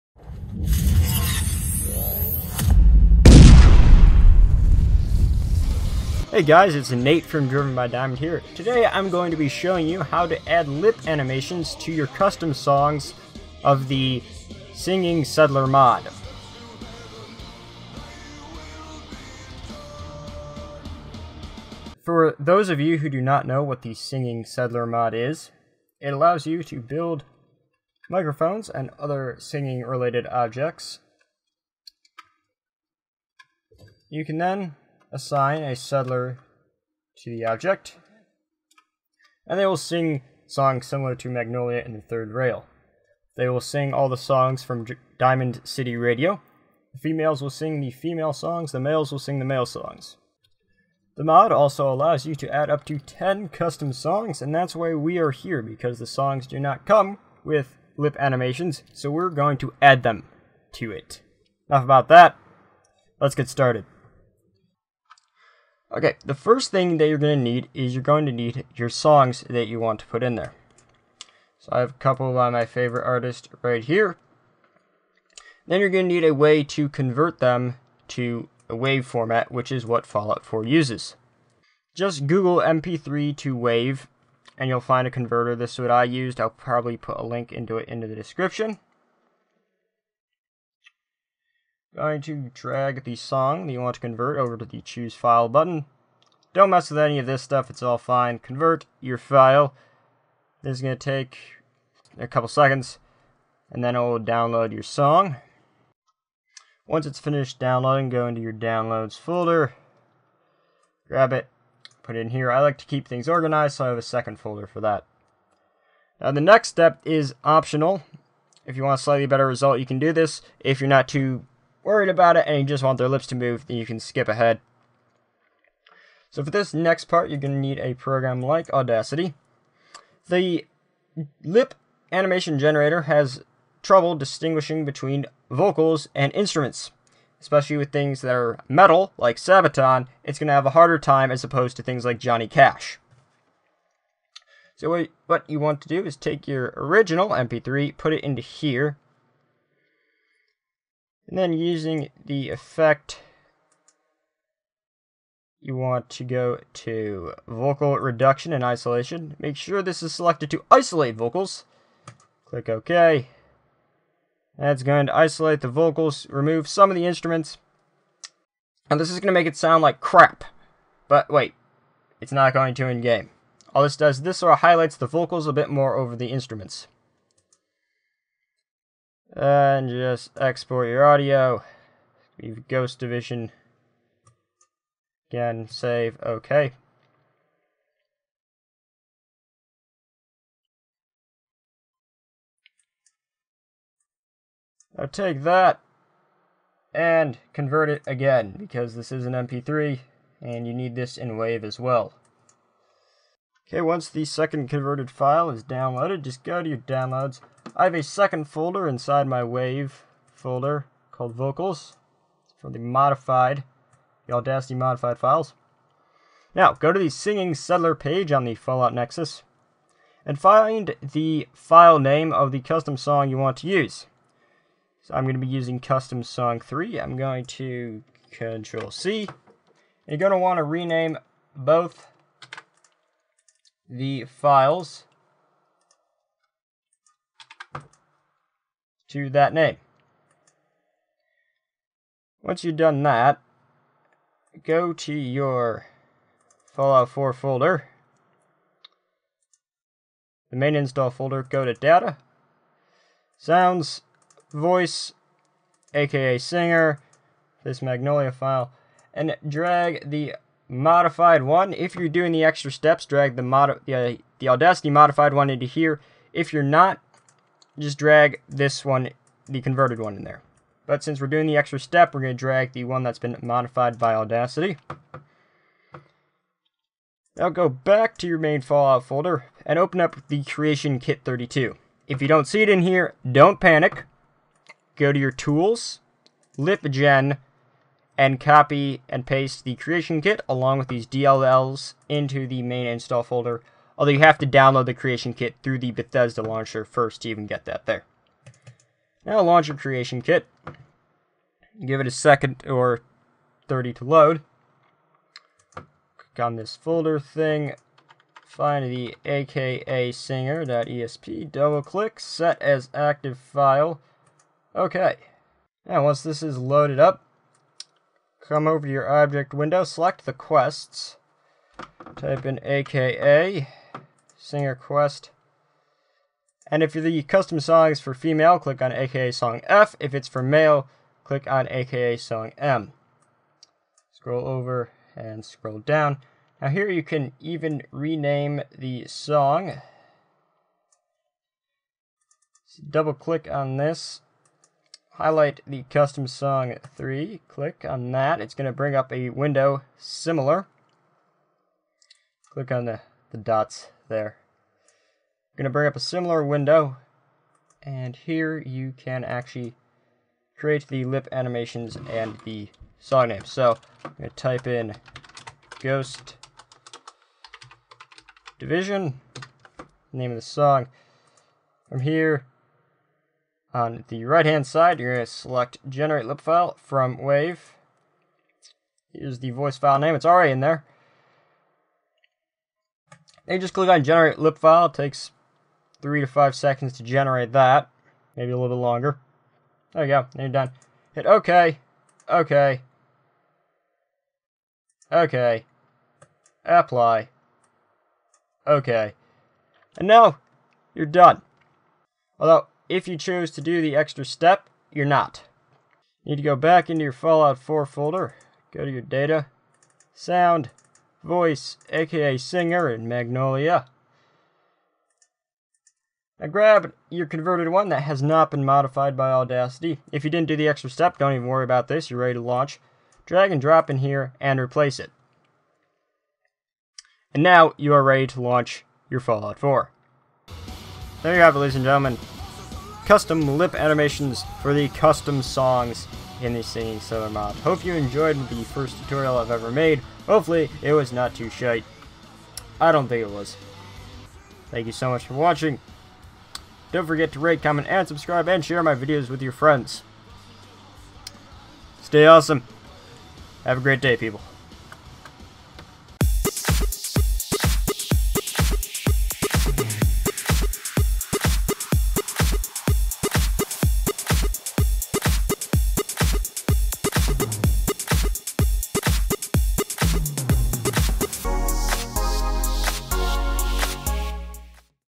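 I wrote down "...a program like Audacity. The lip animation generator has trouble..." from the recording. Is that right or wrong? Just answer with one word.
right.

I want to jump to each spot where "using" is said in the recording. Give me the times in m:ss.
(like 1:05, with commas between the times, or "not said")
2:31, 3:45.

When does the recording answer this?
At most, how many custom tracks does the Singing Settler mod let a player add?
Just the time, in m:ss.
0:52.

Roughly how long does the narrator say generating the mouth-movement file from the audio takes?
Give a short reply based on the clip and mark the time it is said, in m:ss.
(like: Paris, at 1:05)
3 to 5 seconds, at 6:26.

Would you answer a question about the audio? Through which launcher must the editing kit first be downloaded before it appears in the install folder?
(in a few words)
Bethesda launcher.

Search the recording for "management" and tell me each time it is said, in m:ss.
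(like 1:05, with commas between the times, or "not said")
not said.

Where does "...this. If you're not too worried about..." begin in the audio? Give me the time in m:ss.
2:00.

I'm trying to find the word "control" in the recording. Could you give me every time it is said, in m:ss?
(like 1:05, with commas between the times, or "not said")
3:48.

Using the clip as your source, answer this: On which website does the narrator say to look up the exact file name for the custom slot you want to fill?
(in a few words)
Fallout Nexus.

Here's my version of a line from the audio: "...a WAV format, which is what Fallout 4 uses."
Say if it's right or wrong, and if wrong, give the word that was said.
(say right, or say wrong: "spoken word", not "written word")
right.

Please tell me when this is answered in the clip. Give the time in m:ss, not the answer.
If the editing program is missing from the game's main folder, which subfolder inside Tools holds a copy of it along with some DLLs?
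4:46.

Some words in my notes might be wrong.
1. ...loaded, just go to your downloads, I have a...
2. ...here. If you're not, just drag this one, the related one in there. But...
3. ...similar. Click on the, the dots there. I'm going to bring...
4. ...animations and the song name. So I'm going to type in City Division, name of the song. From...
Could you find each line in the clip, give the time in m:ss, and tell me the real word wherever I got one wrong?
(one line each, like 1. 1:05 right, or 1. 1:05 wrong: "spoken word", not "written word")
1. 3:25 wrong: "downloaded", not "loaded"
2. 4:25 wrong: "converted", not "related"
3. 5:49 right
4. 6:01 wrong: "Ghost", not "City".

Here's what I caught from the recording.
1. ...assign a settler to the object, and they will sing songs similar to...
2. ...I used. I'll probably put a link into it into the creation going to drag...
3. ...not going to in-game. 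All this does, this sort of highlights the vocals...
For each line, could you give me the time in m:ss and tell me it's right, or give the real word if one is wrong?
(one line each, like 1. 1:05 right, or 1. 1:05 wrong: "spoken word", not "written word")
1. 0:35 right
2. 1:25 wrong: "description", not "creation"
3. 2:52 right.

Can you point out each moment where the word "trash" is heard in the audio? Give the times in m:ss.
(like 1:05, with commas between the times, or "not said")
not said.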